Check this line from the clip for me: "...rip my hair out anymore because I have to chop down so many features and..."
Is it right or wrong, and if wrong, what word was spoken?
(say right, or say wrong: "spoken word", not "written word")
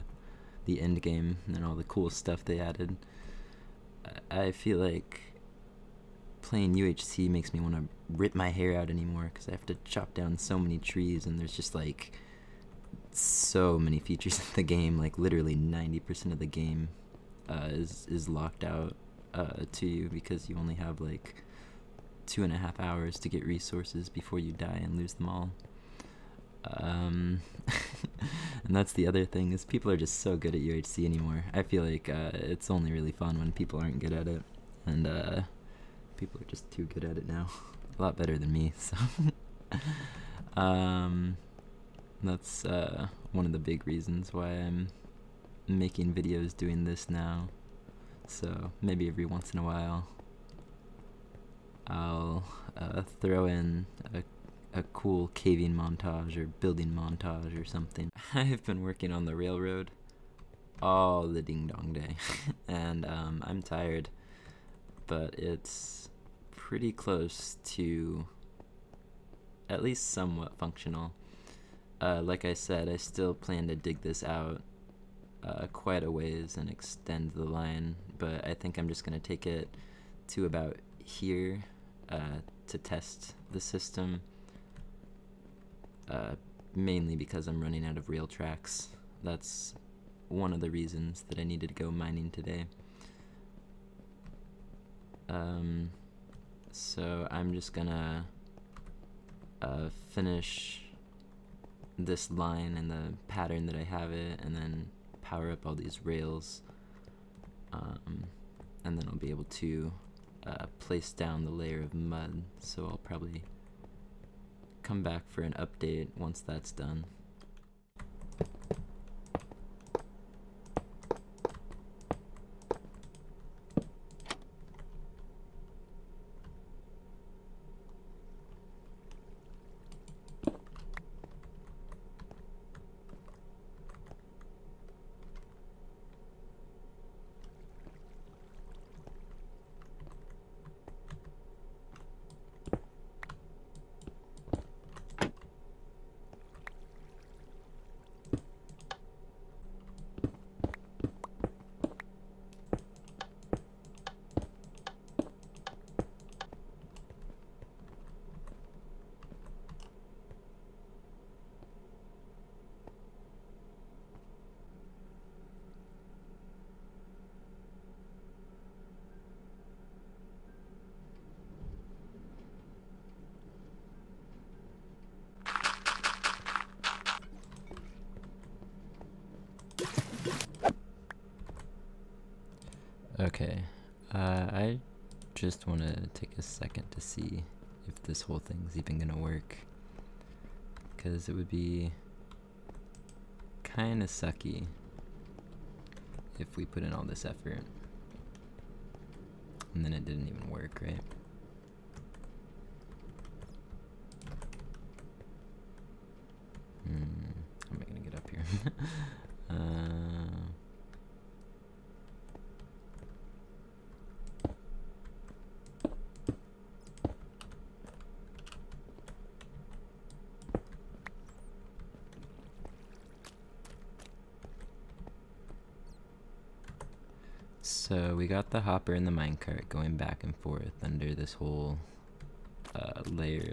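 wrong: "trees", not "features".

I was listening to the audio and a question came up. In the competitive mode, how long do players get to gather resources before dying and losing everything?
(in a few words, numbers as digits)
two and a half hours.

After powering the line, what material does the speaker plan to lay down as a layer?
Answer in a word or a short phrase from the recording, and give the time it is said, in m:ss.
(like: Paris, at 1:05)
mud, at 1:51.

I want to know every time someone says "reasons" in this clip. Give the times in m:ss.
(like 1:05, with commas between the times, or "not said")
0:43, 1:30.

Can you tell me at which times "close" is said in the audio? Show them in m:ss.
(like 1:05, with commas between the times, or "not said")
1:06.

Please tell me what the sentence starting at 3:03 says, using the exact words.
Okay, uh, I just want to take a second to see if this whole thing's even gonna work.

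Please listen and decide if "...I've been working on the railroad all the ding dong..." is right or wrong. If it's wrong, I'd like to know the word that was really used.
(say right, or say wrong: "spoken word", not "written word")
right.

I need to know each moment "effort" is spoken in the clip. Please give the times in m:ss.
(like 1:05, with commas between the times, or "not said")
3:17.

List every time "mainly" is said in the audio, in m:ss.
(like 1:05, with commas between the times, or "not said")
1:26.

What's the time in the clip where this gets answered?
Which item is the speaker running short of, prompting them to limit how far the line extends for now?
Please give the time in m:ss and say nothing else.
1:28.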